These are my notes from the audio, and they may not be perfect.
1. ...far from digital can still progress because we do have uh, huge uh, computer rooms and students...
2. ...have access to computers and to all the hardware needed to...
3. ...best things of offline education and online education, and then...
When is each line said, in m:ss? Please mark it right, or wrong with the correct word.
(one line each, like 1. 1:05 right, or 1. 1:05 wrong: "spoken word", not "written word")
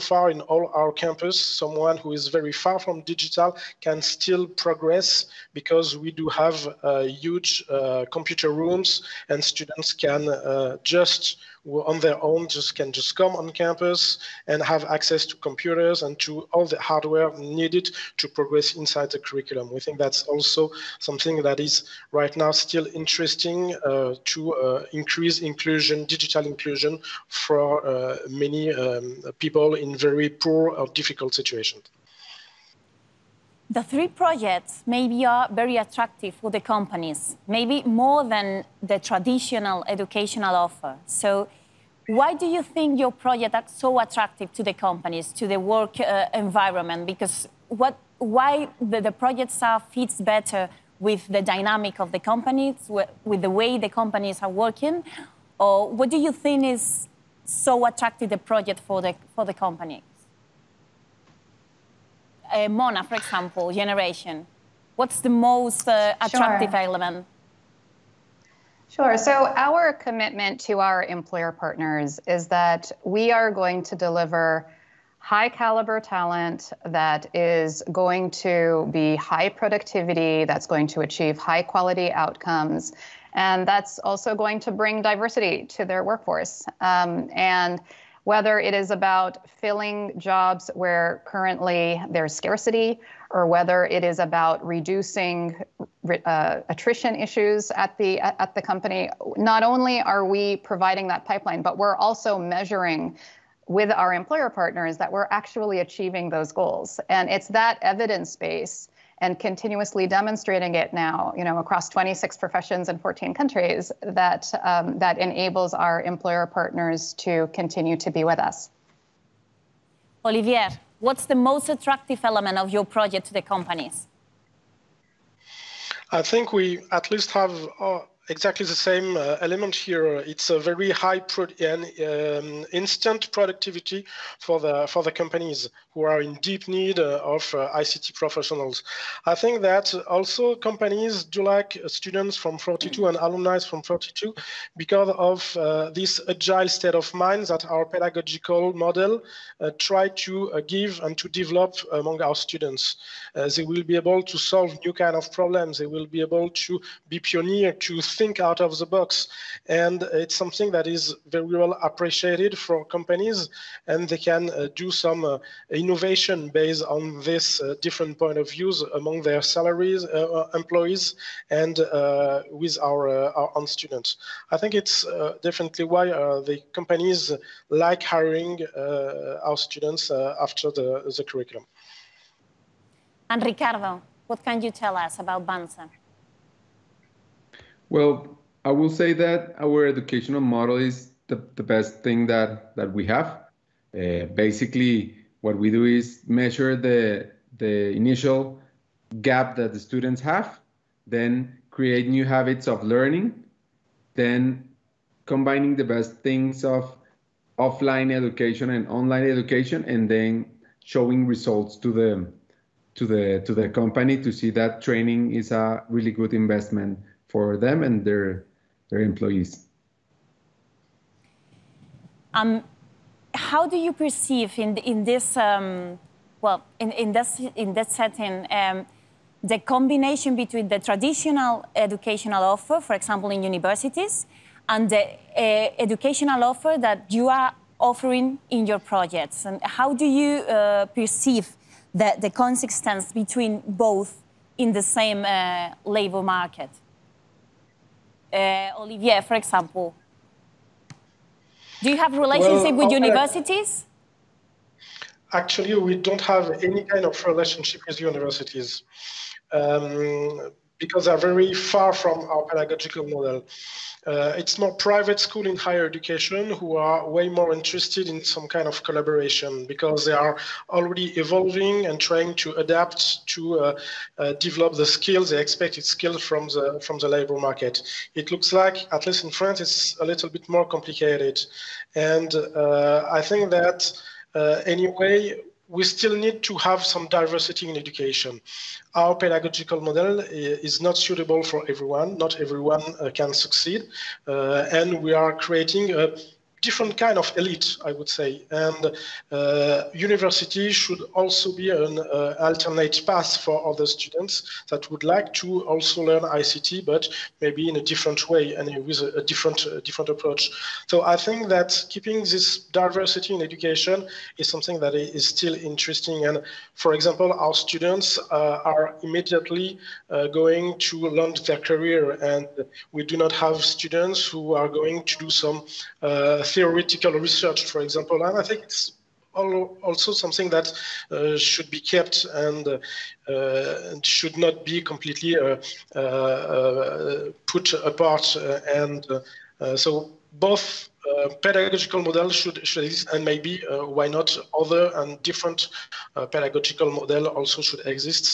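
1. 0:02 right
2. 0:14 right
3. 3:25 right.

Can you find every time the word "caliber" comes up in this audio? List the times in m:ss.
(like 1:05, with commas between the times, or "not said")
1:15.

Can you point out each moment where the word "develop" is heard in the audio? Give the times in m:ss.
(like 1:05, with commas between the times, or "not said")
2:31, 4:34.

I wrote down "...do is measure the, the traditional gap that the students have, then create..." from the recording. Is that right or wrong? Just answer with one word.
wrong.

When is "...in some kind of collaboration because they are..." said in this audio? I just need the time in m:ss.
4:28.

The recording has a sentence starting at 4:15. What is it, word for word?
Actually, we don't have any kind of relationship with universities.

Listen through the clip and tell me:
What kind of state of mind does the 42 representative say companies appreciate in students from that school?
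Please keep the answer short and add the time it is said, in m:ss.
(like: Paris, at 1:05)
agile, at 2:26.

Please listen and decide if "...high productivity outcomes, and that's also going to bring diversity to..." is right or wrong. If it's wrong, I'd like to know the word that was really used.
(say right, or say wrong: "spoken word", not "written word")
wrong: "quality", not "productivity".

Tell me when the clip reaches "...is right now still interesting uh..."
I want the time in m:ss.
0:21.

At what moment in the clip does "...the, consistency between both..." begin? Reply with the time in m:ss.
4:02.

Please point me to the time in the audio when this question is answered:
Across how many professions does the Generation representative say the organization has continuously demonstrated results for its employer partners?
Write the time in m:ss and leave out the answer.
1:51.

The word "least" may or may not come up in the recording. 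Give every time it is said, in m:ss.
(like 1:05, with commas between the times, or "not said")
2:07, 4:39.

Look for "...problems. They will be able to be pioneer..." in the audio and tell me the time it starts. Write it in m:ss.
2:35.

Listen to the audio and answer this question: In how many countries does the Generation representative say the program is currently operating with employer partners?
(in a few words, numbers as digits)
14.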